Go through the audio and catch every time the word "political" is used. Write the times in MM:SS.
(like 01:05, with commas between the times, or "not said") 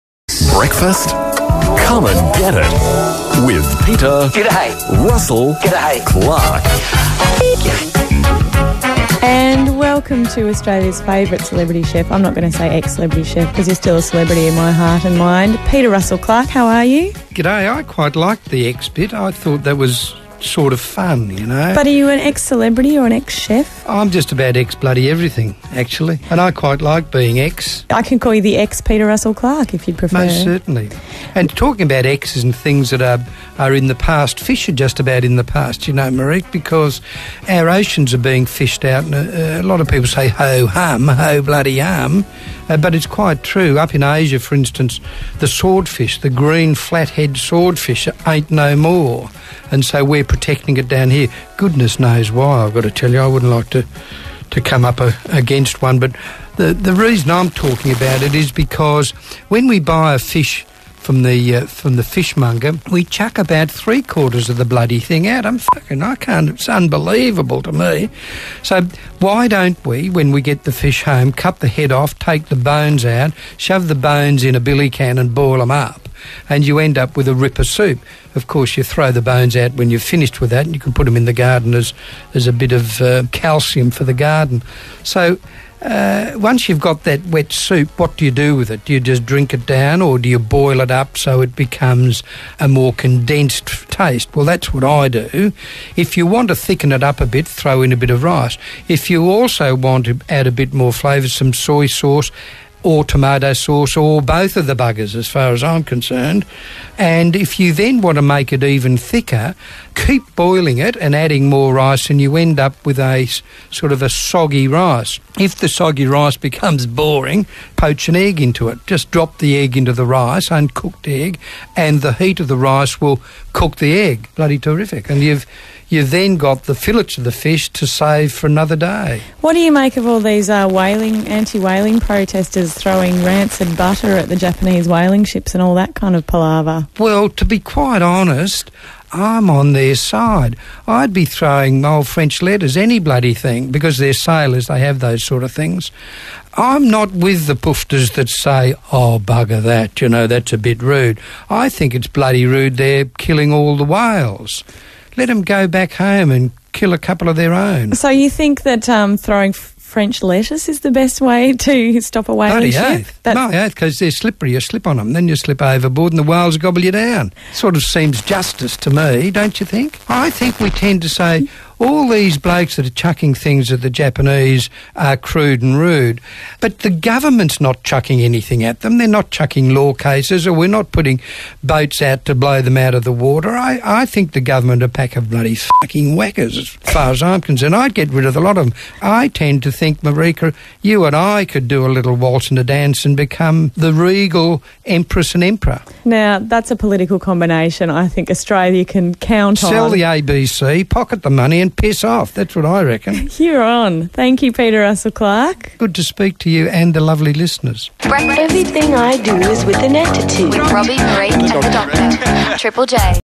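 03:16.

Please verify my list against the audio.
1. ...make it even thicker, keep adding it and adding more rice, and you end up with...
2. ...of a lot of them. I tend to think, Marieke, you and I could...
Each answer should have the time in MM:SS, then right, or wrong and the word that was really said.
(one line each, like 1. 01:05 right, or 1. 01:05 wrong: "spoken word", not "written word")
1. 01:48 wrong: "boiling", not "adding"
2. 03:08 right.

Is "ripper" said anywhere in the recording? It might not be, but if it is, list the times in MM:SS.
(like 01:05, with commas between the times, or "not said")
01:17.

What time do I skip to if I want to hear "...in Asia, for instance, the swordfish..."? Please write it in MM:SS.
00:43.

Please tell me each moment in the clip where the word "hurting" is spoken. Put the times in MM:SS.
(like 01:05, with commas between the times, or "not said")
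not said.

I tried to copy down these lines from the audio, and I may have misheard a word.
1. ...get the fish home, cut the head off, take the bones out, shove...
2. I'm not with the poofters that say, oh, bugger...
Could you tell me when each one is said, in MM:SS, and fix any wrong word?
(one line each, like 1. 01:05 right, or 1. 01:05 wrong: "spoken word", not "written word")
1. 01:10 right
2. 02:26 right.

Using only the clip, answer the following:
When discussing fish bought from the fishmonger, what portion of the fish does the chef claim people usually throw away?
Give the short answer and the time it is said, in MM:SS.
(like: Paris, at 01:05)
three quarters, at 01:03.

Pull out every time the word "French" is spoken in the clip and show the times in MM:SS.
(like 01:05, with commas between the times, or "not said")
02:22, 02:39.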